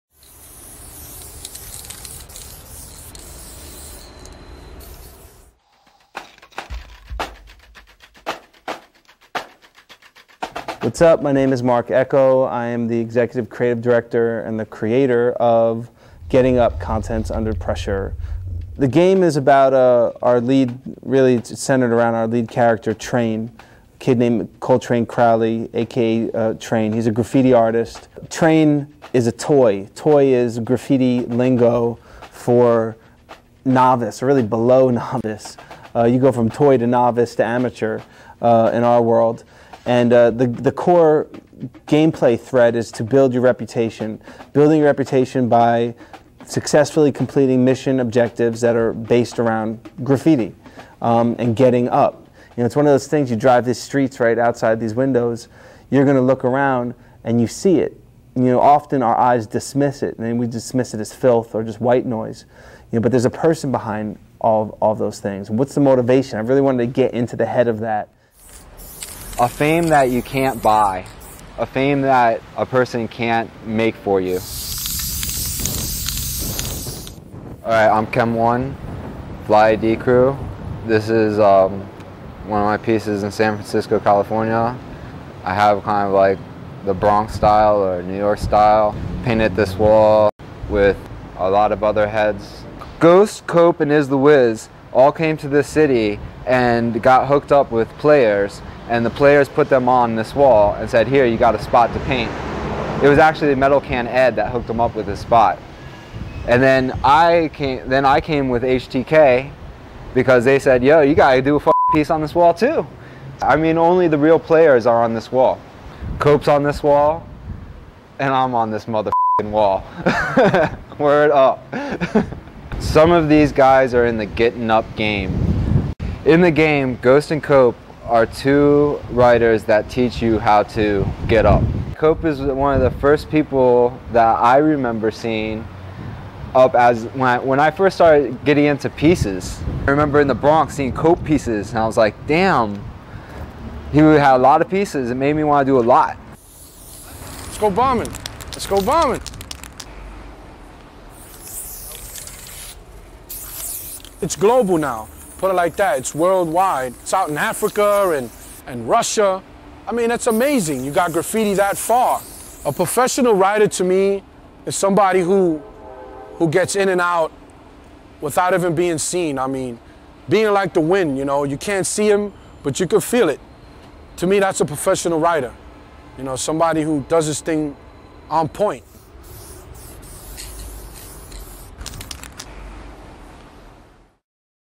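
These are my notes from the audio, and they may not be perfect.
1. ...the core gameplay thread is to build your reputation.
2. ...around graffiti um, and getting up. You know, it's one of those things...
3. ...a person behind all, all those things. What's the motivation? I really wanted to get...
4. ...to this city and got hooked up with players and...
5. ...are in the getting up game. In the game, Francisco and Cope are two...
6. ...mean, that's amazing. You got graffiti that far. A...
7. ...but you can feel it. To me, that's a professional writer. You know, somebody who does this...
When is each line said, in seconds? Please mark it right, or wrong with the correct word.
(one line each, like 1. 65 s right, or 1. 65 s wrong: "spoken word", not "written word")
1. 40 s right
2. 49 s right
3. 63 s right
4. 95 s right
5. 123 s wrong: "Ghost", not "Francisco"
6. 159 s right
7. 172 s right.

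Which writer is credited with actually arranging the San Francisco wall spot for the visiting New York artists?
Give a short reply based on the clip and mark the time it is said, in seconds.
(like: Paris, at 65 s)
Metal Can Ed, at 103 s.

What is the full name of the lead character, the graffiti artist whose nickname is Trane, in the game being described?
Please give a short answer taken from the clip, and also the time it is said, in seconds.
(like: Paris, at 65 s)
Coltrane Crowley, at 24 s.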